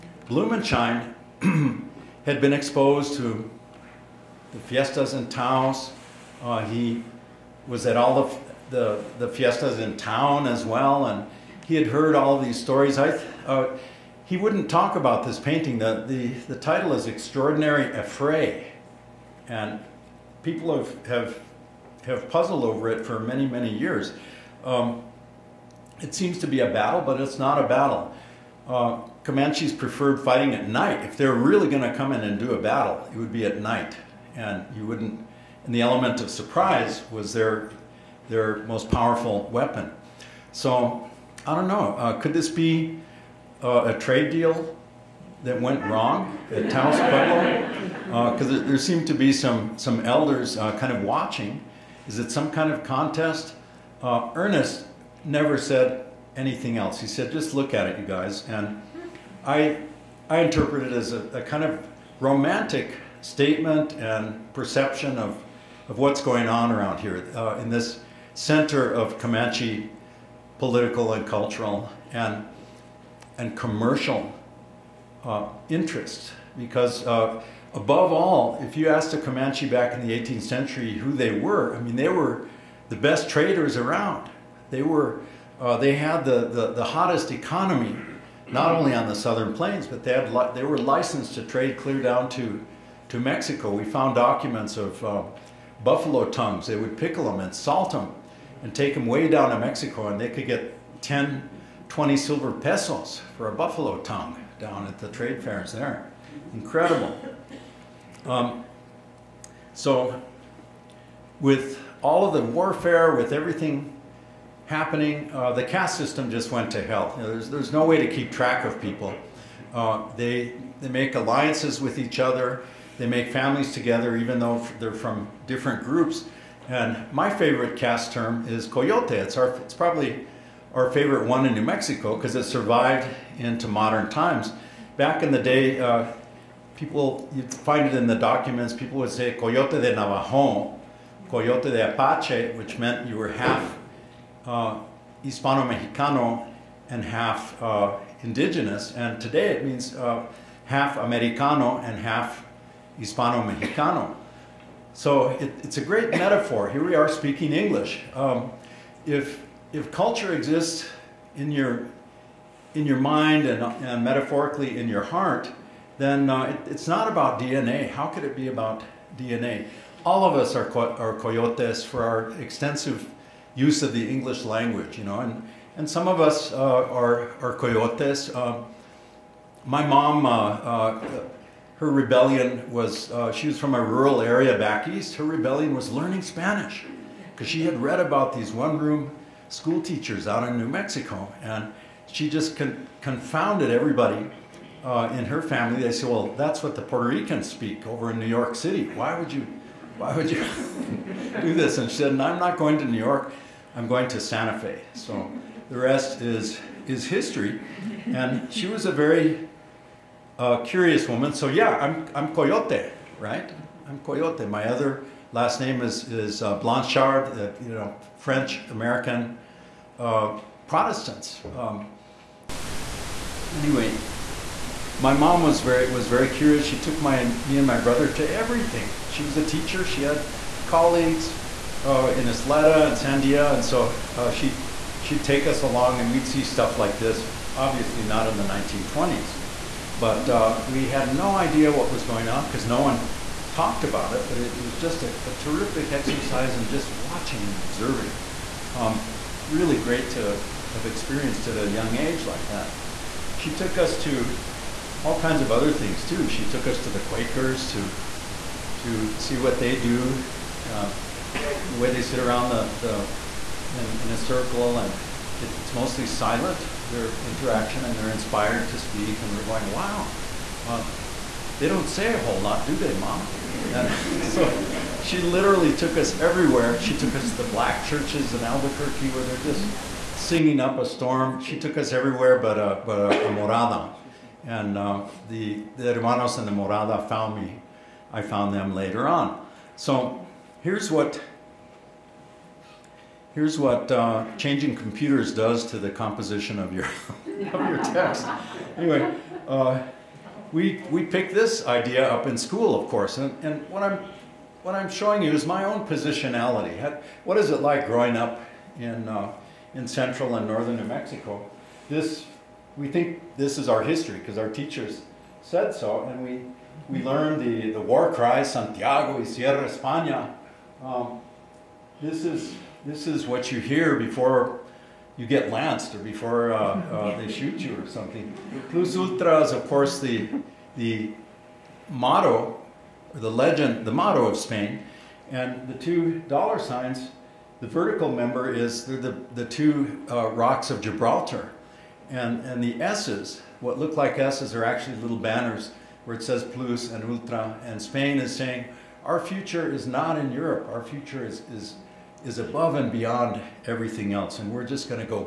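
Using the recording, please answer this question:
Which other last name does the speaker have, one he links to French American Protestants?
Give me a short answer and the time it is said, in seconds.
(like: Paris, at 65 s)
Blanchard, at 216 s.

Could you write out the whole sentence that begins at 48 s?
Because uh, there seemed to be some some elders uh, kind of watching.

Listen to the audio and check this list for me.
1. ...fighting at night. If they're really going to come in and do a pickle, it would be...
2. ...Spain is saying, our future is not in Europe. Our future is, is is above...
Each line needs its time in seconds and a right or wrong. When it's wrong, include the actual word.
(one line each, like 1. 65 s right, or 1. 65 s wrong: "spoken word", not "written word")
1. 30 s wrong: "battle", not "pickle"
2. 347 s right.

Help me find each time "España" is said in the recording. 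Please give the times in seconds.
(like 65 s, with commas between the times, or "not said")
319 s.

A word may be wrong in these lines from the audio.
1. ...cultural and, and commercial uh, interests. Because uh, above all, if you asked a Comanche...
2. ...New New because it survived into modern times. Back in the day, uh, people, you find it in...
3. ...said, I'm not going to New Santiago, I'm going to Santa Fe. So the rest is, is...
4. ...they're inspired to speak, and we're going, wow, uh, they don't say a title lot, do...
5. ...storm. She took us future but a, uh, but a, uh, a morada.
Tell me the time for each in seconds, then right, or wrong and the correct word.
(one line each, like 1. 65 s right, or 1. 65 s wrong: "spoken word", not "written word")
1. 71 s right
2. 131 s wrong: "Mexico", not "New"
3. 201 s wrong: "York", not "Santiago"
4. 267 s wrong: "whole", not "title"
5. 280 s wrong: "everywhere", not "future".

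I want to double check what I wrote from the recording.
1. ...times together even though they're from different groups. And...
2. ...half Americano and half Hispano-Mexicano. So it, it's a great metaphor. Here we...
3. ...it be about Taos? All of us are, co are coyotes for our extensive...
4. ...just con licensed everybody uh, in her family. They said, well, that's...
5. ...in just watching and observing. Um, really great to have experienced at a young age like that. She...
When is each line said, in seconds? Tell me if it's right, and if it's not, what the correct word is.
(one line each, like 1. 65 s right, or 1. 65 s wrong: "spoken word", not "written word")
1. 123 s wrong: "families", not "times"
2. 150 s right
3. 168 s wrong: "DNA", not "Taos"
4. 192 s wrong: "confounded", not "licensed"
5. 246 s right.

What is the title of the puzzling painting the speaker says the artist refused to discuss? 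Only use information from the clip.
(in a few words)
Extraordinary Affray.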